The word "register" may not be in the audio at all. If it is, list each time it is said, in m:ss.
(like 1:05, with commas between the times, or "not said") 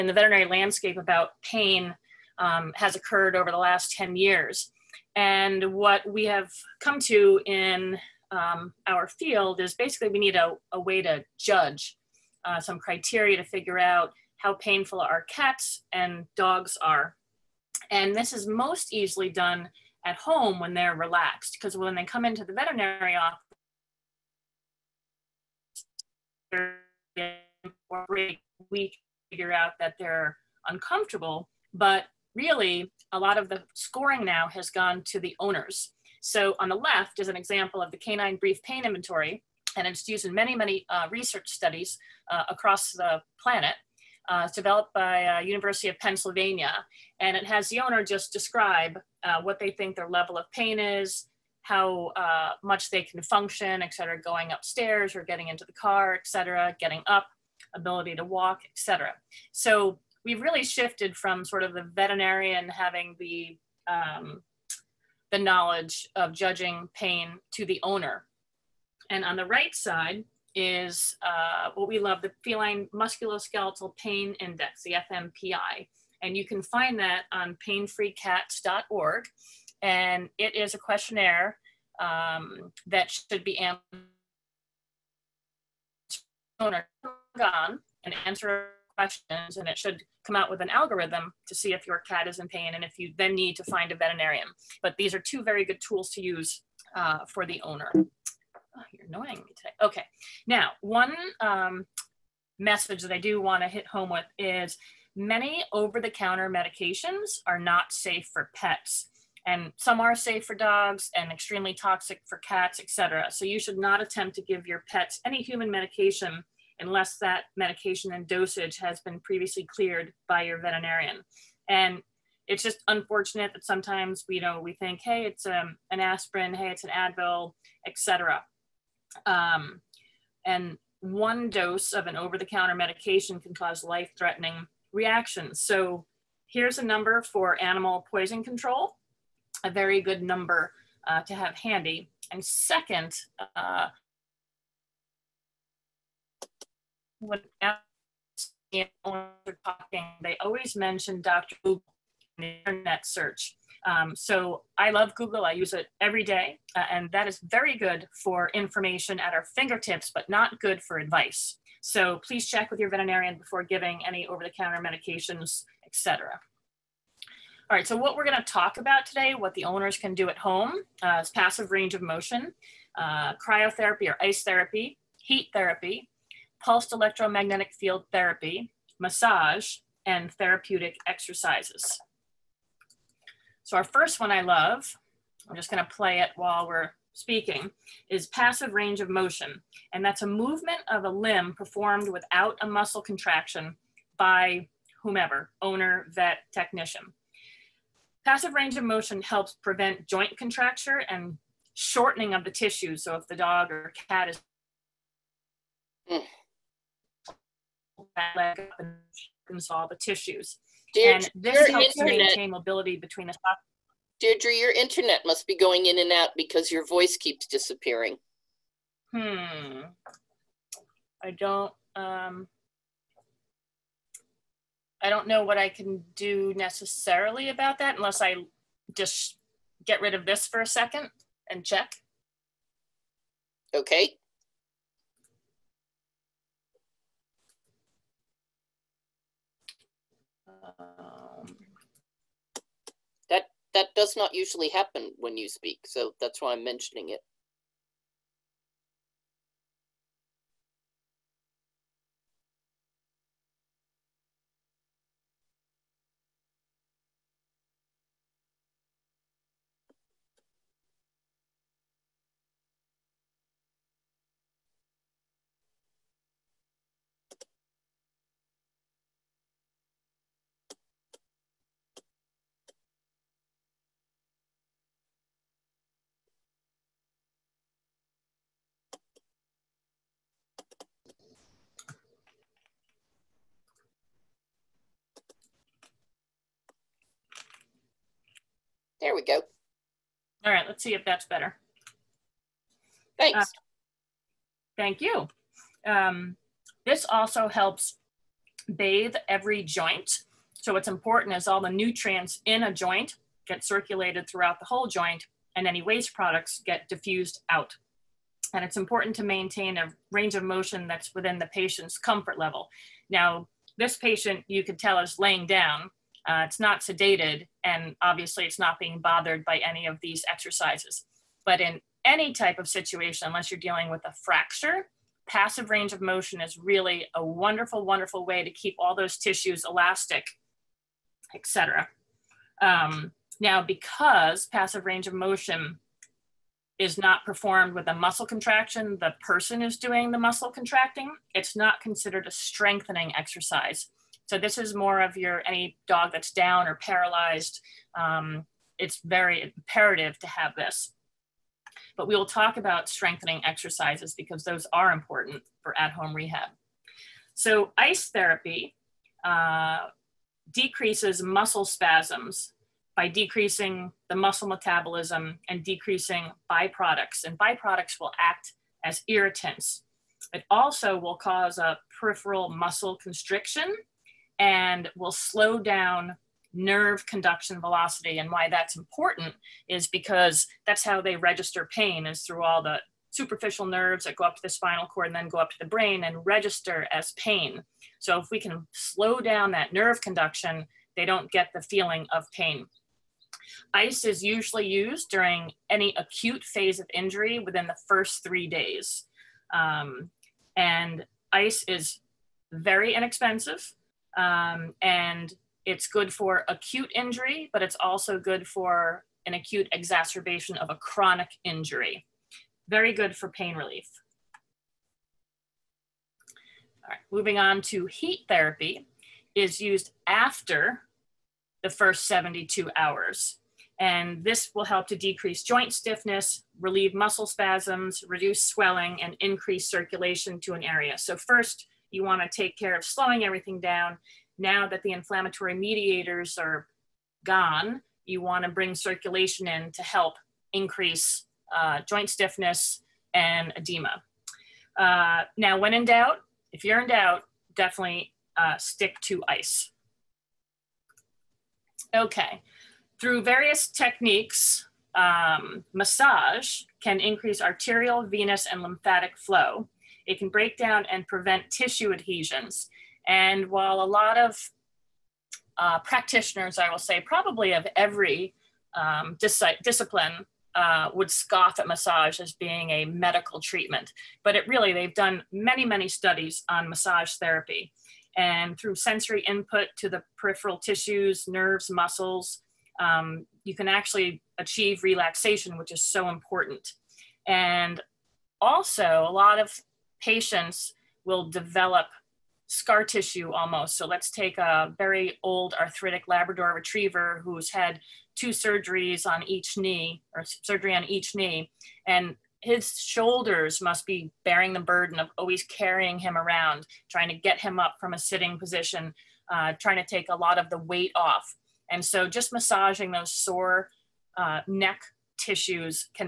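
6:21, 6:26.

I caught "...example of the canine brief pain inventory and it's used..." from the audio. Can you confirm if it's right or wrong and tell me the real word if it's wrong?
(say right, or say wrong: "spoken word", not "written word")
right.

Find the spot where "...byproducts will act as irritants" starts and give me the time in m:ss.
6:07.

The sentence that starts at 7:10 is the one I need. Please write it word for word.
So first, you want to take care of slowing everything down.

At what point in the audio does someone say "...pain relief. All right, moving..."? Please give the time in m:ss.
6:53.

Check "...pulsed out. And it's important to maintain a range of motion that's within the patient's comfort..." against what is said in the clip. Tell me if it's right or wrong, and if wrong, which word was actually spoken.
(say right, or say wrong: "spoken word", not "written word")
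wrong: "diffused", not "pulsed".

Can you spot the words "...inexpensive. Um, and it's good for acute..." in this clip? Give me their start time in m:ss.
6:42.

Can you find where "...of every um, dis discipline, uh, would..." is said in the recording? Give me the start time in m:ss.
7:47.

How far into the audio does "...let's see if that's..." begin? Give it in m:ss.
4:50.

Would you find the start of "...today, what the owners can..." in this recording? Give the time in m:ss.
2:49.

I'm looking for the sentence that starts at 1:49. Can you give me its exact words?
And some are safe for dogs and extremely toxic for cats, etc.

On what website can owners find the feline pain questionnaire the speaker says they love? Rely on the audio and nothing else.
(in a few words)
painfreecats.org.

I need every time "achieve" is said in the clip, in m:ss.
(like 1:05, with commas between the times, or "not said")
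8:04.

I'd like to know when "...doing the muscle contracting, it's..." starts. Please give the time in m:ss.
5:39.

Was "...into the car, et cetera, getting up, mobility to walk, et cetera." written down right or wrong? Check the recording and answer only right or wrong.
wrong.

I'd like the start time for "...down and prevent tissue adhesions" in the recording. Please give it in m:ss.
7:40.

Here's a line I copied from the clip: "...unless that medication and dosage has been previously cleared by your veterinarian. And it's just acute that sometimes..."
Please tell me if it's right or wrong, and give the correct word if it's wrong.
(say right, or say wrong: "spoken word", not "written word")
wrong: "unfortunate", not "acute".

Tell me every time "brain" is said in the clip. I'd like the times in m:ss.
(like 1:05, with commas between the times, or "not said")
6:25.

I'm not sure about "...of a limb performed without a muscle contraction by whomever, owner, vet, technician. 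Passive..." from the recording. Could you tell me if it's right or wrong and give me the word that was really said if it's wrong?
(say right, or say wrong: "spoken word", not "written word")
right.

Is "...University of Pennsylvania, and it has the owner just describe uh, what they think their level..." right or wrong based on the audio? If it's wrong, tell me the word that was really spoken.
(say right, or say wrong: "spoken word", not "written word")
right.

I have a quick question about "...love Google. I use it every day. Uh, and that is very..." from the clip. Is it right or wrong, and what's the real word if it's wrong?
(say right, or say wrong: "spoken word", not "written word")
right.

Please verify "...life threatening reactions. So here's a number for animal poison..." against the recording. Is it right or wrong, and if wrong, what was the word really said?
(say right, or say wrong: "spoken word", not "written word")
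right.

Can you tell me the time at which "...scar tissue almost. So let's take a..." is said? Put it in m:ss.
8:12.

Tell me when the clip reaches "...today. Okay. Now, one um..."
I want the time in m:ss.
1:39.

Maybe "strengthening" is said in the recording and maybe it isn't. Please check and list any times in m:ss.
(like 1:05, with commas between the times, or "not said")
5:42, 5:52.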